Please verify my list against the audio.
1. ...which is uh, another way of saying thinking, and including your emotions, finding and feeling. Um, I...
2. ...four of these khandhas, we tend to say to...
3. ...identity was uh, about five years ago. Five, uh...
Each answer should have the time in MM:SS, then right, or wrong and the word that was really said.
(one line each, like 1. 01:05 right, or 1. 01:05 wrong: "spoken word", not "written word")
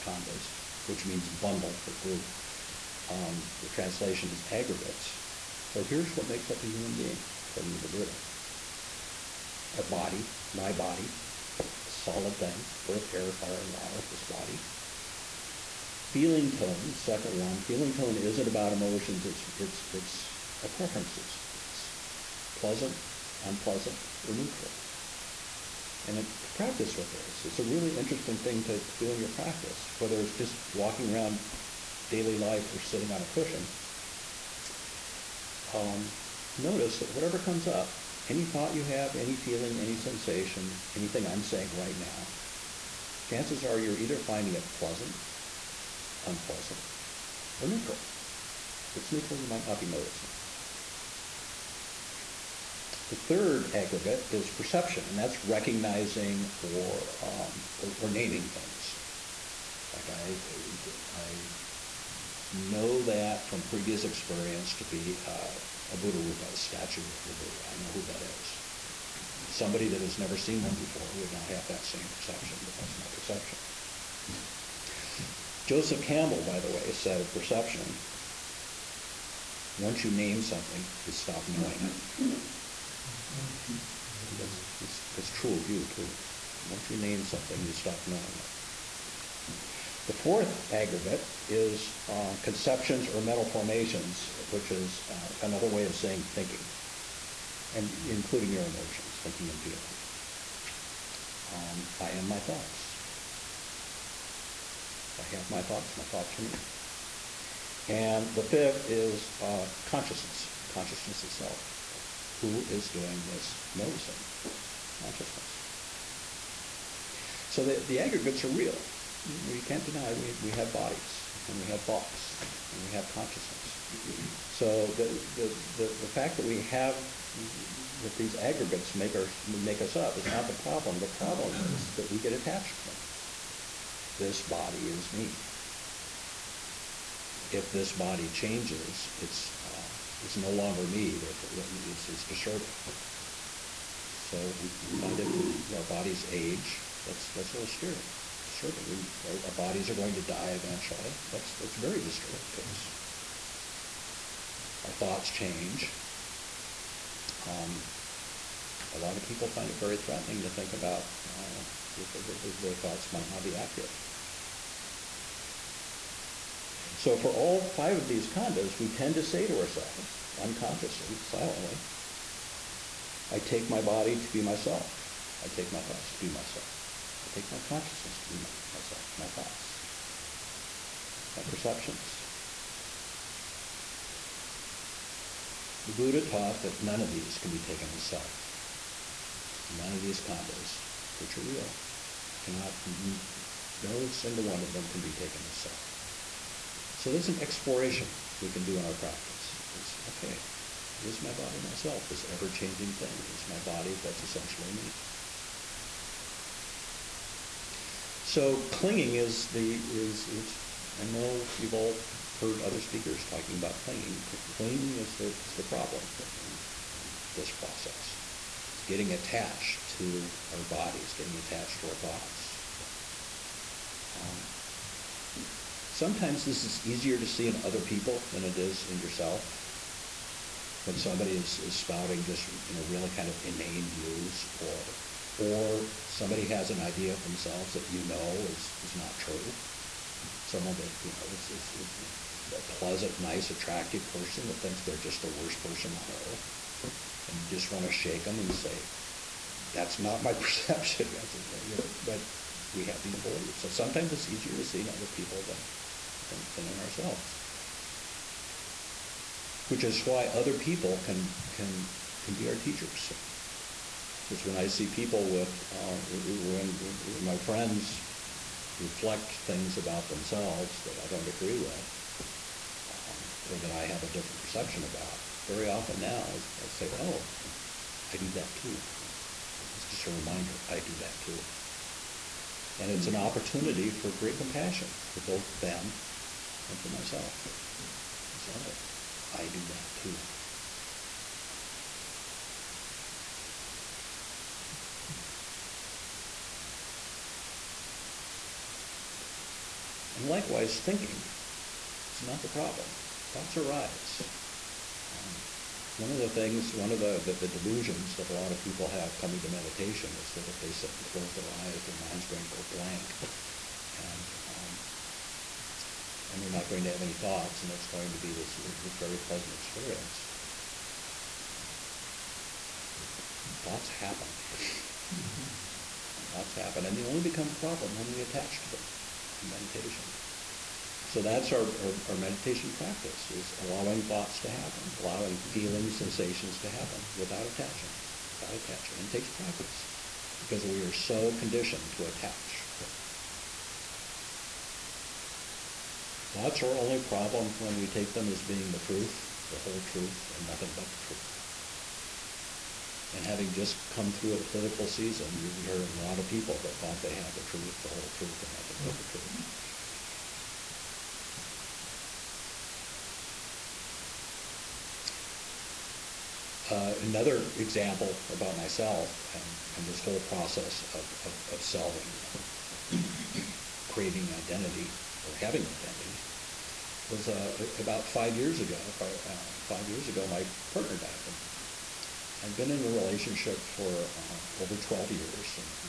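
1. 01:34 wrong: "thinking", not "finding"
2. 02:47 wrong: "five", not "four"
3. 06:15 right.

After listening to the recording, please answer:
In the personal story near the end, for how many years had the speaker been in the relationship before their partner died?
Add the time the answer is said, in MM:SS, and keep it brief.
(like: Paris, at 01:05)
over 12 years, at 06:24.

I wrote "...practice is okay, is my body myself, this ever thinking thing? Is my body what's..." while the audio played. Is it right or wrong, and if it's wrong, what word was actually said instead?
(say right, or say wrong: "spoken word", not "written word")
wrong: "changing", not "thinking".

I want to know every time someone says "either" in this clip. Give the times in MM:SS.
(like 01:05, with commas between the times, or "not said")
00:43.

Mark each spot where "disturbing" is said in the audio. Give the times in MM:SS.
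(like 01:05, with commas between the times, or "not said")
02:22, 02:31.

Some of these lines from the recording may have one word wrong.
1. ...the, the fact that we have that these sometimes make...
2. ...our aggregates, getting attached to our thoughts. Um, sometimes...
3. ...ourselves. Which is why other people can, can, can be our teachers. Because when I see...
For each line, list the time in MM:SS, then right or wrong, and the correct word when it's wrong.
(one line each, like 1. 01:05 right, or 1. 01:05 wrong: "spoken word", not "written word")
1. 02:05 wrong: "aggregates", not "sometimes"
2. 03:40 wrong: "bodies", not "aggregates"
3. 04:16 right.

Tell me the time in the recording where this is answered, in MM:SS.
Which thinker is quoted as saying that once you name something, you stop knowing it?
01:15.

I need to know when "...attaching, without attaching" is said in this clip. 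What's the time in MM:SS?
05:37.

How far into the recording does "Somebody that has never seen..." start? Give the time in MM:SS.
01:09.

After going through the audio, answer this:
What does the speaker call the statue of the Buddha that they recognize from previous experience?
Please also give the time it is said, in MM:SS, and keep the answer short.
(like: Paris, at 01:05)
Buddha Rupa, at 01:05.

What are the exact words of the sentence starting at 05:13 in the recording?
And um, and they're not going to have any thoughts, and it's going to be this very pleasant experience.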